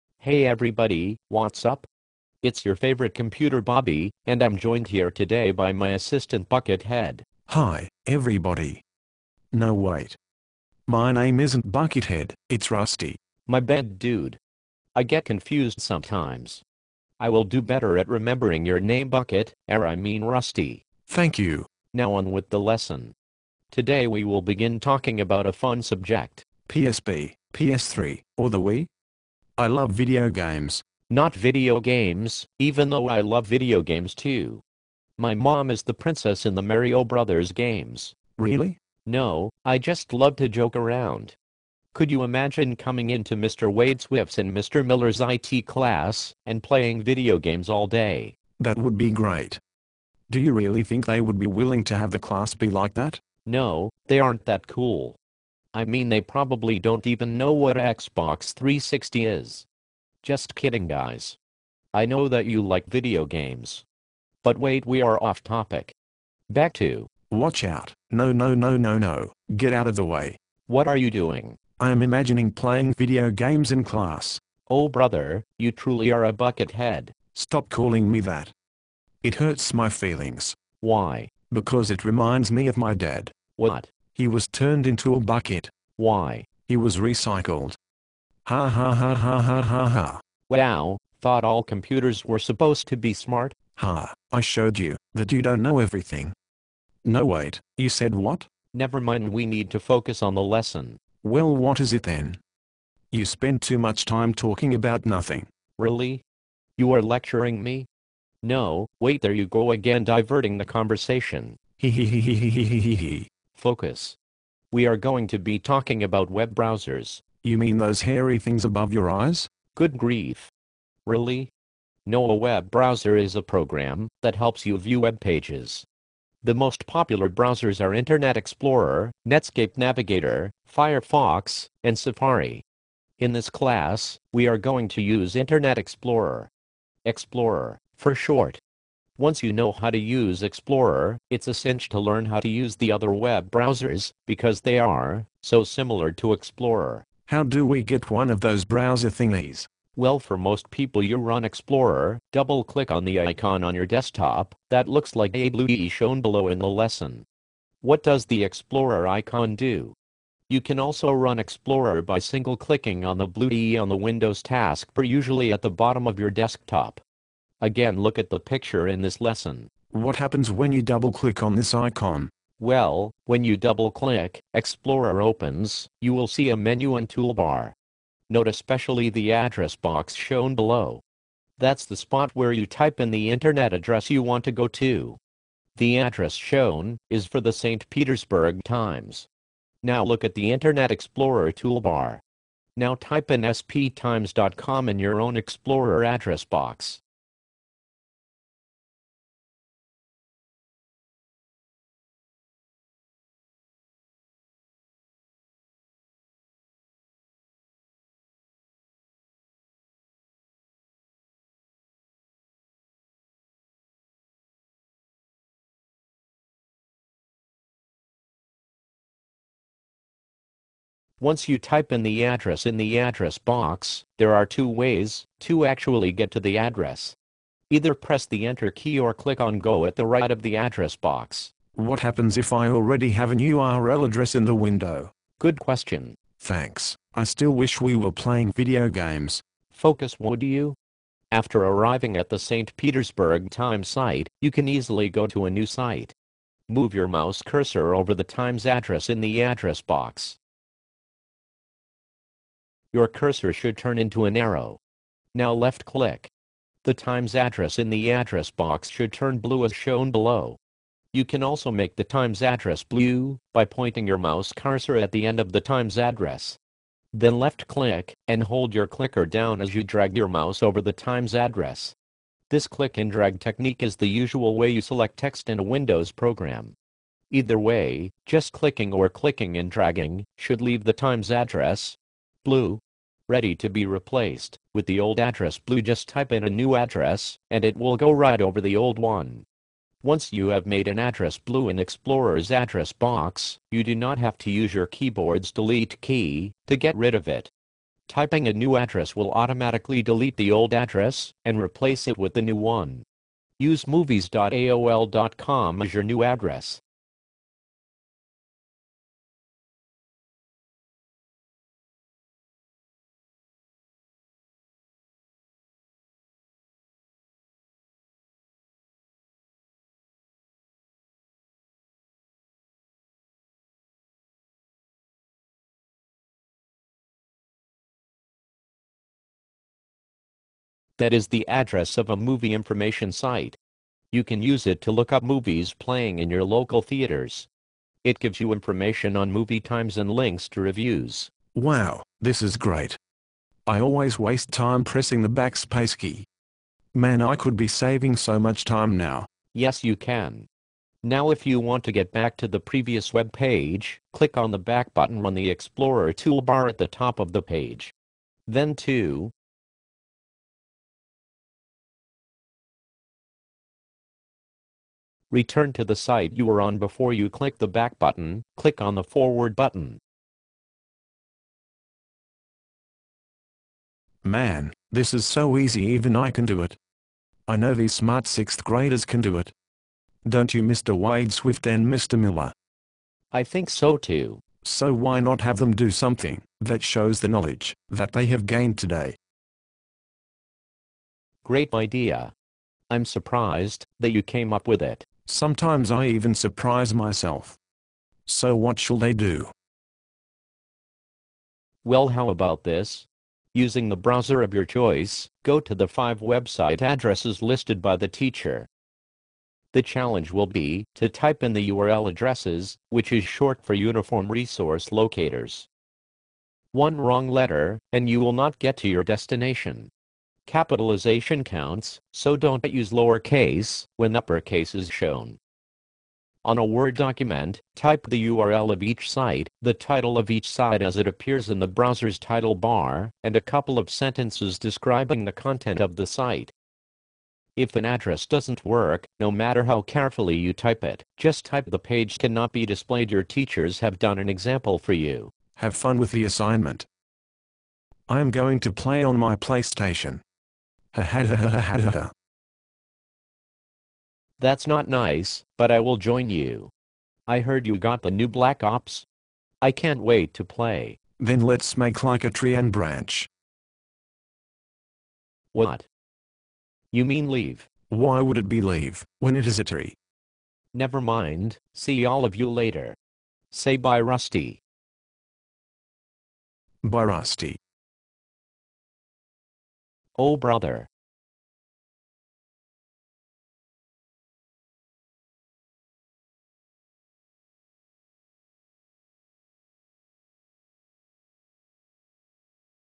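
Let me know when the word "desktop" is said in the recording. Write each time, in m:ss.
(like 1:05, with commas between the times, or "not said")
2:33, 2:46.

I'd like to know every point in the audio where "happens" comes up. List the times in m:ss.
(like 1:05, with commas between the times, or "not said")
2:50, 3:51.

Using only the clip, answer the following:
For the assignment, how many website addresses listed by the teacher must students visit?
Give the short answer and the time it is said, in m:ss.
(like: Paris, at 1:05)
5, at 6:45.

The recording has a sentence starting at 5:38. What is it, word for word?
It gives you information on movie times and links to reviews.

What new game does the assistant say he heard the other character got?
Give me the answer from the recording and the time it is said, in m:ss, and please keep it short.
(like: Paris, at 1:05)
Black Ops, at 7:38.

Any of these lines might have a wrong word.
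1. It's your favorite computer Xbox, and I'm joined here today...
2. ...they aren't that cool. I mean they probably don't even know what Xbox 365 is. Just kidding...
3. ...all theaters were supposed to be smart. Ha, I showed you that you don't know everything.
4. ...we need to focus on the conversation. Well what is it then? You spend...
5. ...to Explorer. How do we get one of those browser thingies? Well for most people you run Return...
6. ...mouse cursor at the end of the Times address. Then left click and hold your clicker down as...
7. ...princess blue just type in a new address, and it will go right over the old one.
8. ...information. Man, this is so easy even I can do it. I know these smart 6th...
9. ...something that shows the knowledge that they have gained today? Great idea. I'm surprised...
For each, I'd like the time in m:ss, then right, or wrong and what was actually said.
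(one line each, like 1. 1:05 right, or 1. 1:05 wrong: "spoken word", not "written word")
1. 0:02 wrong: "Bobby", not "Xbox"
2. 0:54 wrong: "360", not "365"
3. 1:31 wrong: "computers", not "theaters"
4. 1:39 wrong: "lesson", not "conversation"
5. 2:26 wrong: "Explorer", not "Return"
6. 4:24 right
7. 4:45 wrong: "address", not "princess"
8. 6:09 wrong: "button", not "information"
9. 6:25 right.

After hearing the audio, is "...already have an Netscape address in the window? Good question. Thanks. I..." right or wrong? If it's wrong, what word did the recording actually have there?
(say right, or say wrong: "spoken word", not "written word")
wrong: "URL", not "Netscape".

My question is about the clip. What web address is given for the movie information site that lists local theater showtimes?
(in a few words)
movies.aol.com.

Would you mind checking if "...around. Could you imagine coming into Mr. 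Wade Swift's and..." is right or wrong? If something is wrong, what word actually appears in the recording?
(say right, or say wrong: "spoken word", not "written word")
right.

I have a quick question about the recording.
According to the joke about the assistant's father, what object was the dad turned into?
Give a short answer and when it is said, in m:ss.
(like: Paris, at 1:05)
a bucket, at 1:25.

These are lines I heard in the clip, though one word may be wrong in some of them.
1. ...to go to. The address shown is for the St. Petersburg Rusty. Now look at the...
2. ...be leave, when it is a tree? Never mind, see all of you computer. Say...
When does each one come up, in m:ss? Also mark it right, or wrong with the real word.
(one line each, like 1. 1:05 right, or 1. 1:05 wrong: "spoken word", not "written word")
1. 3:04 wrong: "Times", not "Rusty"
2. 7:48 wrong: "later", not "computer".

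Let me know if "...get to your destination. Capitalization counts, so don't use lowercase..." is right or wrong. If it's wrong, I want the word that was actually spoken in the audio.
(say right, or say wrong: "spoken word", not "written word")
right.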